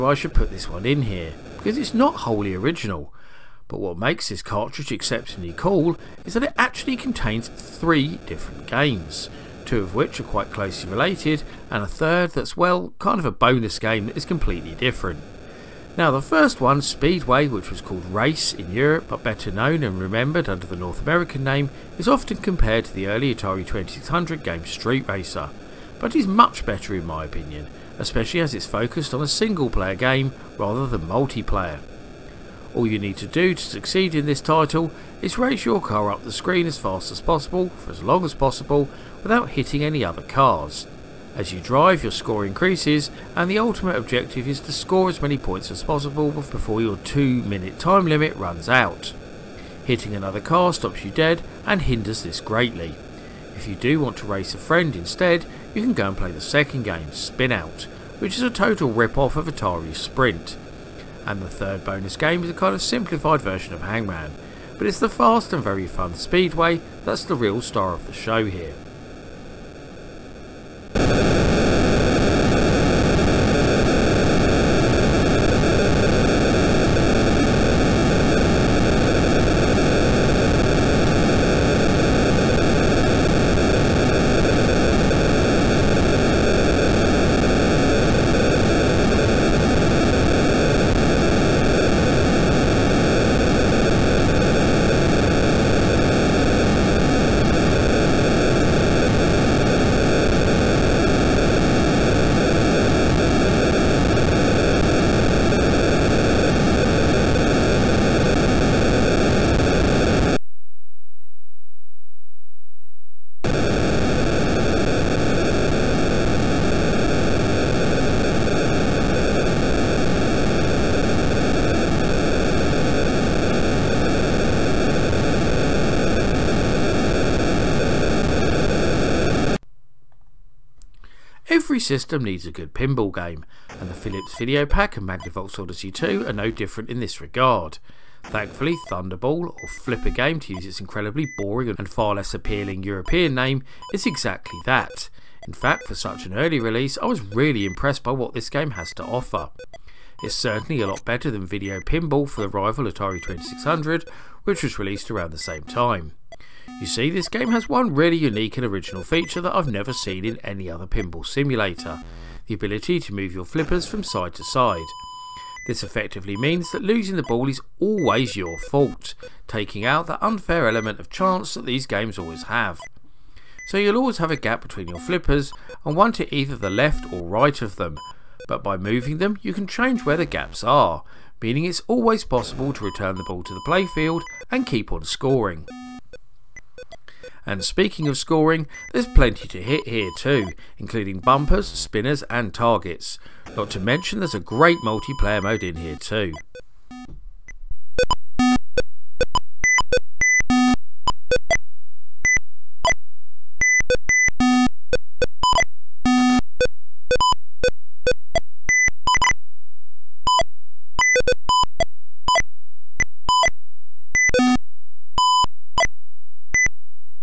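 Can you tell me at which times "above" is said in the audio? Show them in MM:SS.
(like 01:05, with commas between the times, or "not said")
not said.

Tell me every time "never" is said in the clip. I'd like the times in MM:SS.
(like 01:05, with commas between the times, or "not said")
02:39.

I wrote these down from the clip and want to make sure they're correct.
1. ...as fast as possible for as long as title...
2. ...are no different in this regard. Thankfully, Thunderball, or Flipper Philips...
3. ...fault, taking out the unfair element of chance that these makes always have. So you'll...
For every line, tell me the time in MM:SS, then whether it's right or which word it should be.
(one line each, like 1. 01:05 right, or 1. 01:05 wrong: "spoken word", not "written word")
1. 00:36 wrong: "possible", not "title"
2. 02:16 wrong: "Game", not "Philips"
3. 02:48 wrong: "games", not "makes".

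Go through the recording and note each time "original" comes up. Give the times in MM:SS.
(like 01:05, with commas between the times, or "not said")
00:02, 02:38.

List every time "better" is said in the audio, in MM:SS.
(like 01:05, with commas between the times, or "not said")
00:19, 00:26, 02:31.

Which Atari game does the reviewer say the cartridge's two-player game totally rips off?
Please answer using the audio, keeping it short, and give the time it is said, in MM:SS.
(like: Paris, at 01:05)
Atari Sprint, at 00:59.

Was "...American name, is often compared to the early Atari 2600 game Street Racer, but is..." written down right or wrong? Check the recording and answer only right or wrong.
right.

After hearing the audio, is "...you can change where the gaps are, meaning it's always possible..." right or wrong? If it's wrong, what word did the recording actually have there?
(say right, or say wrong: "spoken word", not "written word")
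right.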